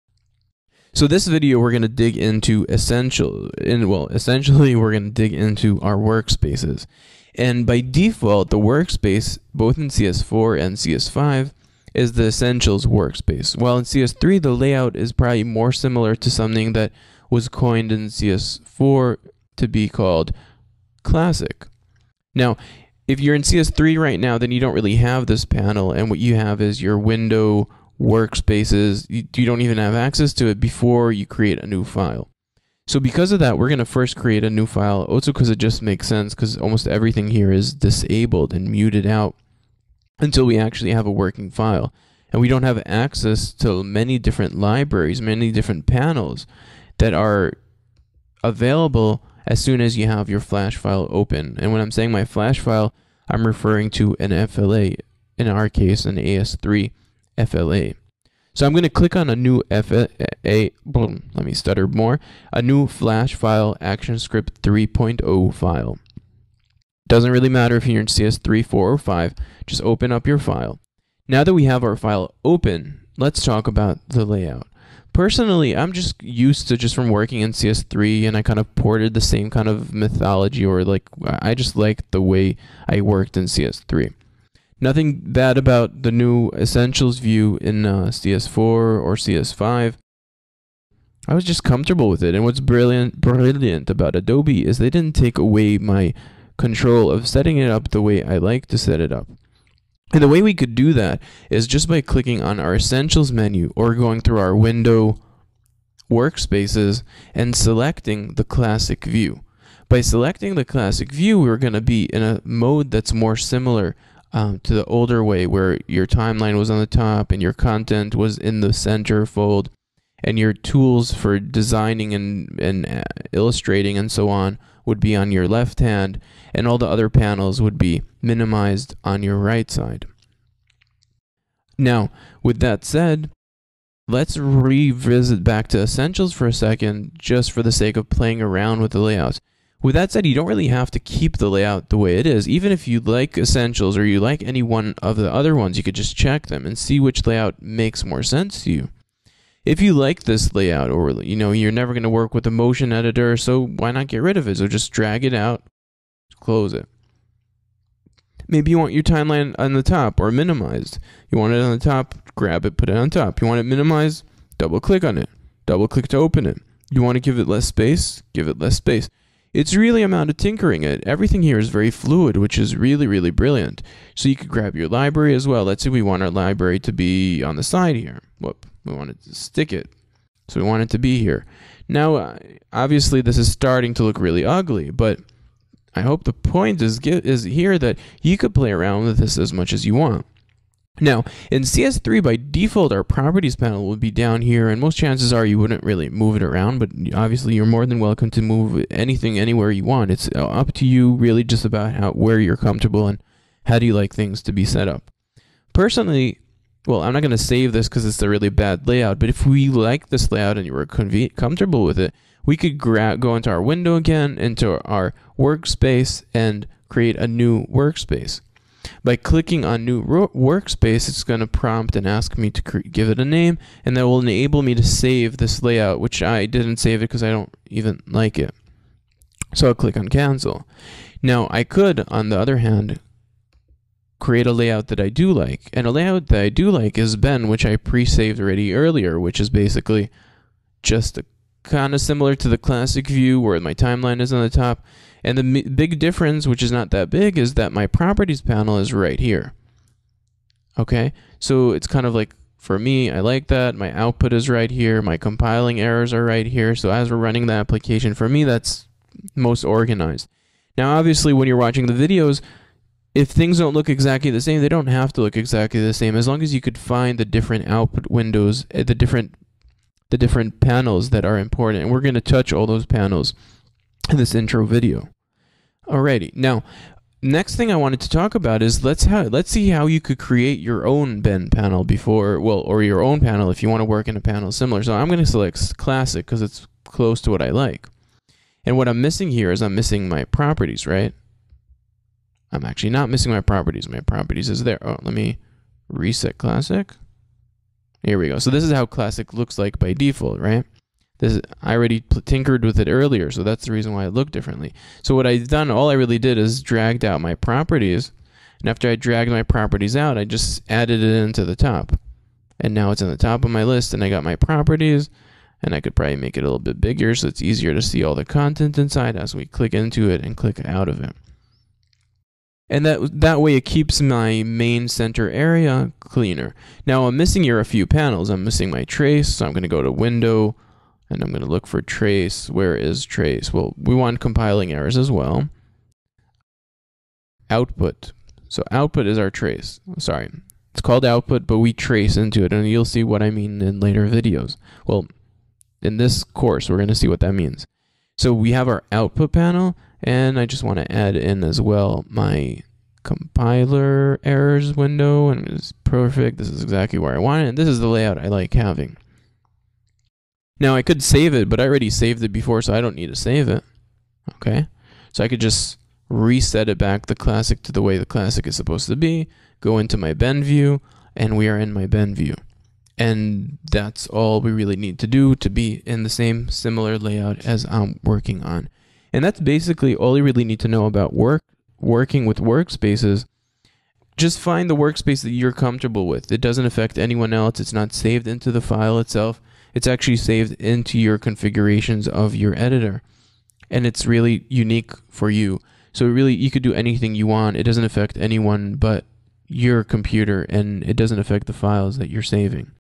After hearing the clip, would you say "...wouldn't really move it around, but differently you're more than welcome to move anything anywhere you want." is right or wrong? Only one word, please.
wrong.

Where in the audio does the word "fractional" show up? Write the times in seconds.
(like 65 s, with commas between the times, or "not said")
not said.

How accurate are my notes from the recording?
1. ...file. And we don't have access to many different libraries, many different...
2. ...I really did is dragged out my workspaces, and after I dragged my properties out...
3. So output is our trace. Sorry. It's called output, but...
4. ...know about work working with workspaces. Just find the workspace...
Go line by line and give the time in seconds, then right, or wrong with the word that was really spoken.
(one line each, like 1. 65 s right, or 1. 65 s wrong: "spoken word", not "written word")
1. 41 s right
2. 305 s wrong: "properties", not "workspaces"
3. 338 s right
4. 380 s right.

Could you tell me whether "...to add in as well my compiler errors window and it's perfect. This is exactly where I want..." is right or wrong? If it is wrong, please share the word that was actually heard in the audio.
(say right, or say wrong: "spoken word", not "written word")
right.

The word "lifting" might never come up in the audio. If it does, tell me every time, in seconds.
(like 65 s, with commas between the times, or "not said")
not said.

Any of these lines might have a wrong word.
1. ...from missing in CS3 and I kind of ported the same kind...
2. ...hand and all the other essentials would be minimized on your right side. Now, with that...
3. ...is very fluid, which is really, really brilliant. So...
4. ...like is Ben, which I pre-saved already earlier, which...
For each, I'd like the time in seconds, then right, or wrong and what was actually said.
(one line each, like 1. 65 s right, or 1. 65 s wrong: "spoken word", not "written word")
1. 76 s wrong: "working", not "missing"
2. 125 s wrong: "panels", not "essentials"
3. 171 s right
4. 236 s right.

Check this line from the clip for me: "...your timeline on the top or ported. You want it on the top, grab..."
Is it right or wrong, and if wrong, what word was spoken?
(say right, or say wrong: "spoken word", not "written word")
wrong: "minimized", not "ported".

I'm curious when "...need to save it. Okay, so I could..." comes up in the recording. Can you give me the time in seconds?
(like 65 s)
362 s.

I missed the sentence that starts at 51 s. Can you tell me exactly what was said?
And when I'm saying my flash file, I'm referring to an FLA, in our case, an AS3 FLA.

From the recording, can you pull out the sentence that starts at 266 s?
As long as you could find the different output windows, eh, the different the different panels that are important.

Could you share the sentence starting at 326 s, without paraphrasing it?
Now I'm missing here a few panels.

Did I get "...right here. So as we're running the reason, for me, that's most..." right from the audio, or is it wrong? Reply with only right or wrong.
wrong.